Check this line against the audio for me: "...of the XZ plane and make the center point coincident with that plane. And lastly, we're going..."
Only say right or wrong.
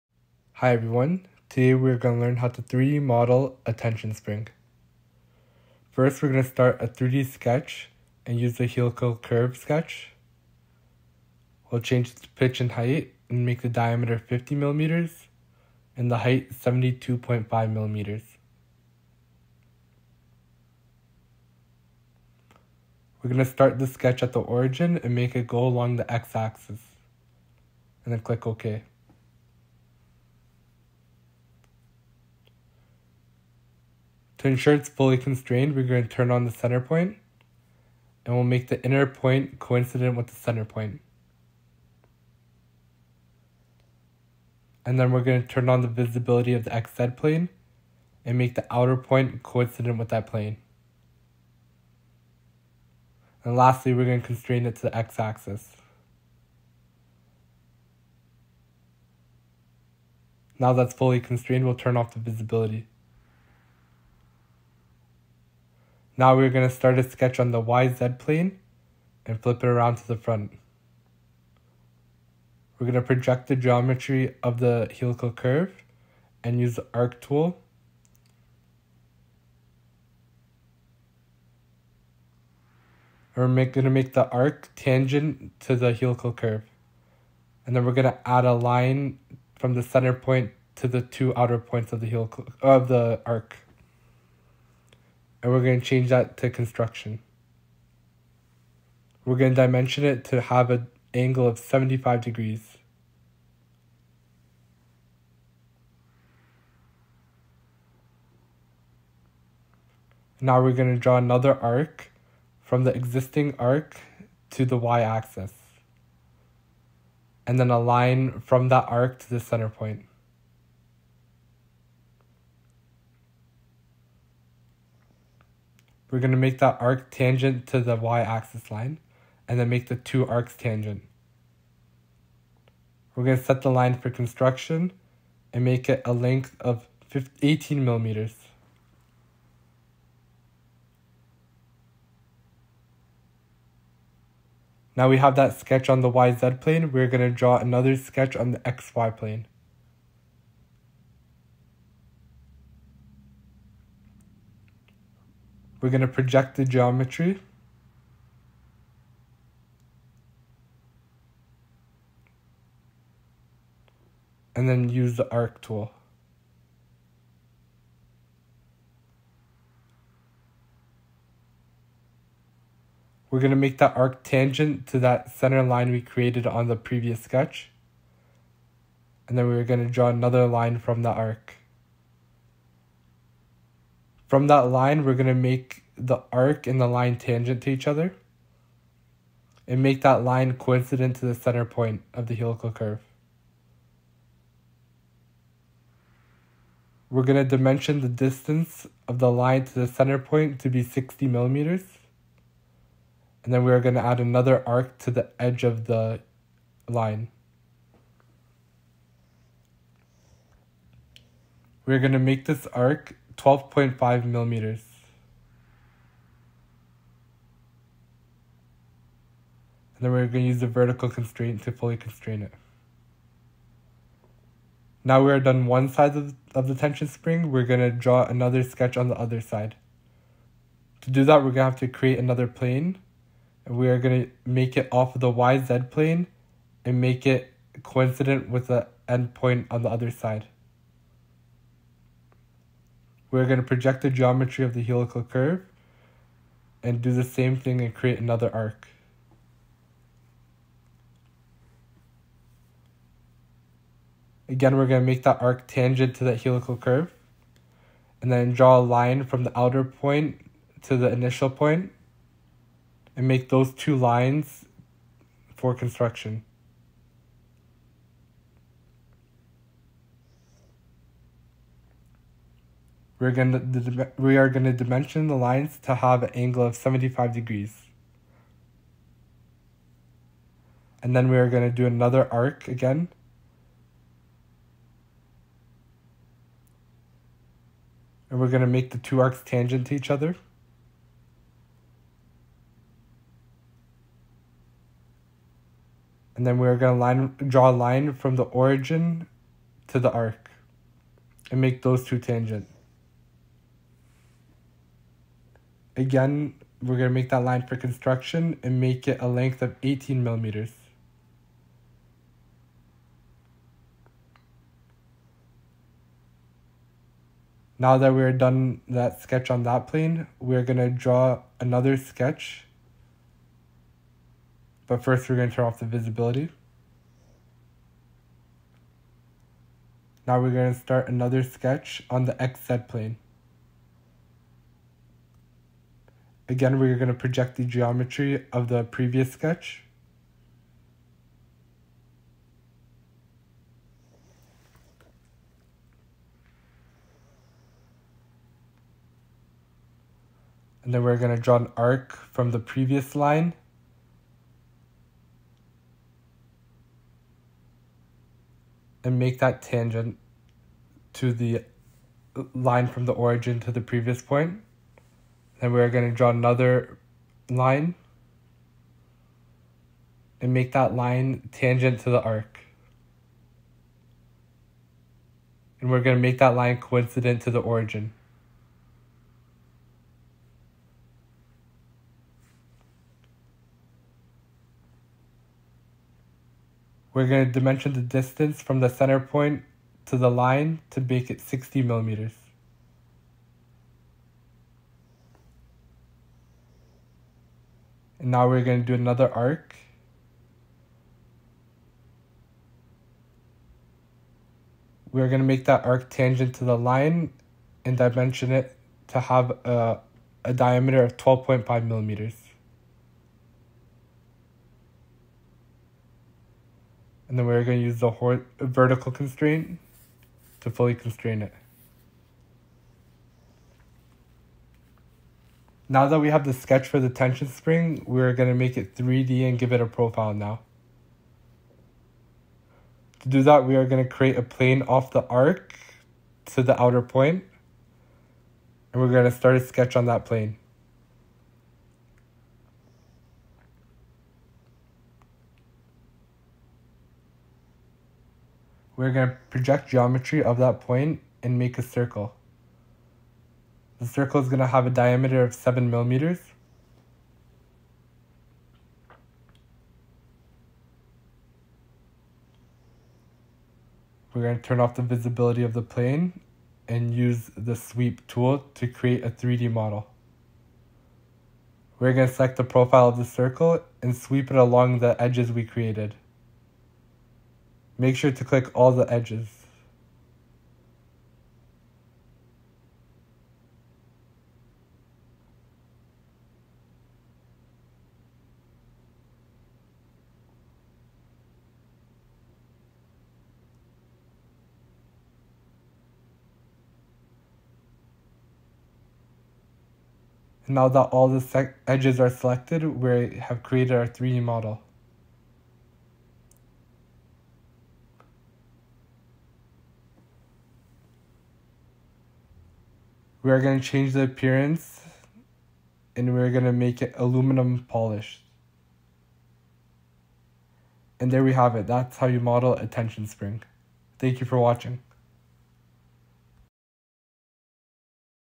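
wrong.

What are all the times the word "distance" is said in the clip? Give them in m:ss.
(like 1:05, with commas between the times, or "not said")
3:18, 6:28.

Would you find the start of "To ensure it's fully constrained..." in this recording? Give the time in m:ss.
0:34.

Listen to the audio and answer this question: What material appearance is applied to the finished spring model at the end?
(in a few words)
Aluminum polished.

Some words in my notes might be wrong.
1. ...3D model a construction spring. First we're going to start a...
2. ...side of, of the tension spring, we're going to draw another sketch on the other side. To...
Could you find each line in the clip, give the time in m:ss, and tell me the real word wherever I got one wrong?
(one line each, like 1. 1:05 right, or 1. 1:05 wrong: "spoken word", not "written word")
1. 0:02 wrong: "tension", not "construction"
2. 3:45 right.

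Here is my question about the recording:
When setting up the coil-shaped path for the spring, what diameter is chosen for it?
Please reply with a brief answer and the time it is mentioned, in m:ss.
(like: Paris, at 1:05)
50 millimeters, at 0:14.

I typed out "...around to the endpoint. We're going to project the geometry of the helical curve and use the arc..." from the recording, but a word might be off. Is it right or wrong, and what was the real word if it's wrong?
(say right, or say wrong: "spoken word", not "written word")
wrong: "front", not "endpoint".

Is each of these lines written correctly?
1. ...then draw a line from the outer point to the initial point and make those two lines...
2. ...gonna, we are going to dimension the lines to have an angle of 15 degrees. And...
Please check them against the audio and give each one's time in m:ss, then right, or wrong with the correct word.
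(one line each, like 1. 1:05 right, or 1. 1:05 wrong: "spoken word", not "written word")
1. 4:18 right
2. 4:33 wrong: "75", not "15".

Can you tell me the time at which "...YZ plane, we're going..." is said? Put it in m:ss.
2:26.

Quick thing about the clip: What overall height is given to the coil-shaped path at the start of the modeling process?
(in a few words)
72.5 millimeters.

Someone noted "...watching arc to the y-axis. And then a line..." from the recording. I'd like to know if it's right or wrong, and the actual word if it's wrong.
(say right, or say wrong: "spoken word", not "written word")
wrong: "existing", not "watching".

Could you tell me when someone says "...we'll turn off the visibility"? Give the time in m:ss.
1:01.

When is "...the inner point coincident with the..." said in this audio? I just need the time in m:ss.
0:38.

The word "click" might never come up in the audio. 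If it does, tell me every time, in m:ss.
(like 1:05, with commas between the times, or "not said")
0:28, 7:58.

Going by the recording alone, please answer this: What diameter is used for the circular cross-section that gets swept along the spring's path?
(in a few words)
7 millimeters.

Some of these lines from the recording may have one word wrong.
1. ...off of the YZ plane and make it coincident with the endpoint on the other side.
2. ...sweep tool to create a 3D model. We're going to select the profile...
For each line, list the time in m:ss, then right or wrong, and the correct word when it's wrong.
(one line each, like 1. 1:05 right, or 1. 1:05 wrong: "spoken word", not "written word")
1. 3:54 right
2. 7:47 right.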